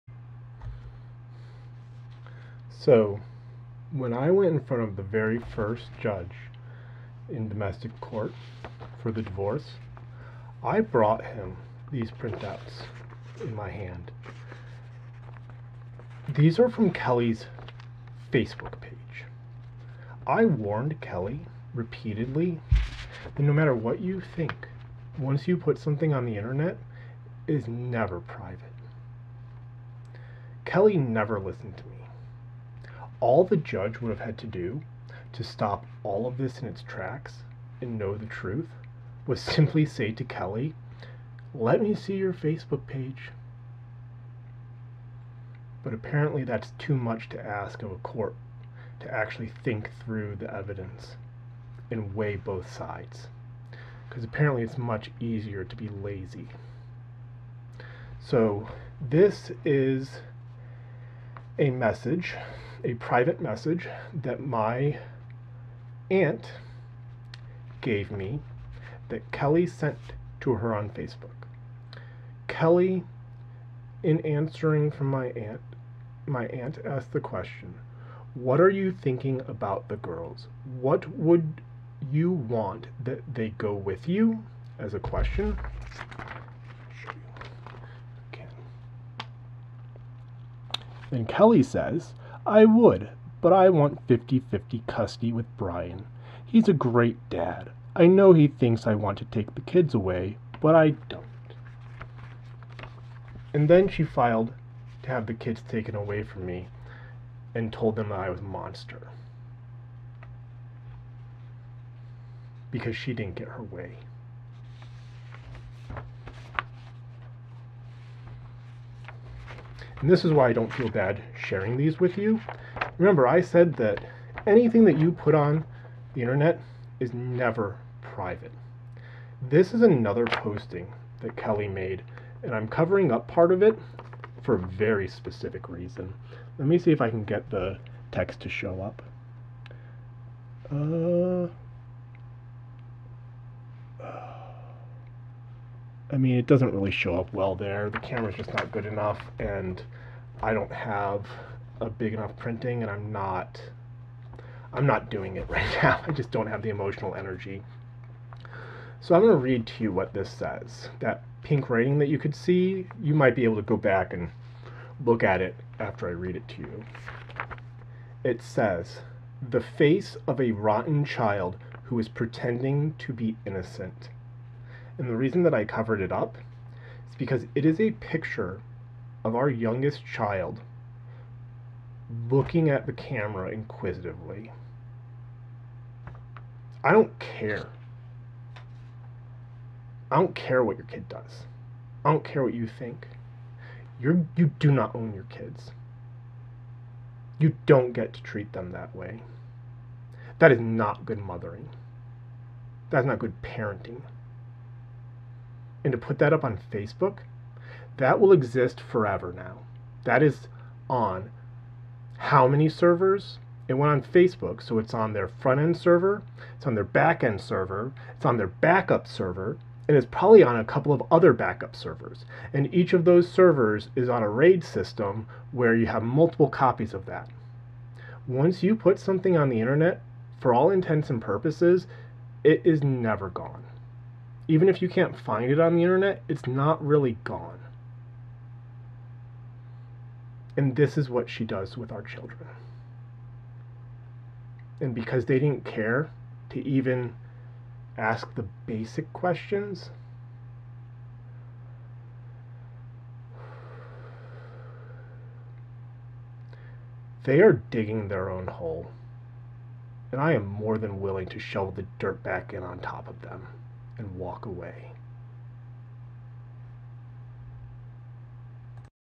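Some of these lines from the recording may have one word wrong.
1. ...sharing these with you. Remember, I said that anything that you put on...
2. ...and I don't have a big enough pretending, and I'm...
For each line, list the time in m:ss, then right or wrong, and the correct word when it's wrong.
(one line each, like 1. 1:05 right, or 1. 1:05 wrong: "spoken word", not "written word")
1. 2:01 right
2. 2:29 wrong: "printing", not "pretending".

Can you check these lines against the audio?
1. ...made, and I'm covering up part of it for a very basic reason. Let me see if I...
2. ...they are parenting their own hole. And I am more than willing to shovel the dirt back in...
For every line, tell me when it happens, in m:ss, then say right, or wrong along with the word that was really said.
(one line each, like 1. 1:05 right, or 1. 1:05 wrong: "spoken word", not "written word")
1. 2:11 wrong: "specific", not "basic"
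2. 4:17 wrong: "digging", not "parenting".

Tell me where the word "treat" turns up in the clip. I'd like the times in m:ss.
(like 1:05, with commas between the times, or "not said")
3:18.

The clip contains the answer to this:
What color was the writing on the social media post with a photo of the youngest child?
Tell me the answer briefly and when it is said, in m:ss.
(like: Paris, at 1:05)
pink, at 2:41.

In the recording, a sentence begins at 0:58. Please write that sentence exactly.
So, this is a message a private message that my aunt gave me that Kelly sent to her on Facebook.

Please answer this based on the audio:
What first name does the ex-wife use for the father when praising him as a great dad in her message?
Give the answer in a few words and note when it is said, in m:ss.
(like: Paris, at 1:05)
Brian, at 1:35.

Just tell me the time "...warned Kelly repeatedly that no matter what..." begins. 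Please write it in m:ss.
0:20.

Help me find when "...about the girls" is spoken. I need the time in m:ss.
1:19.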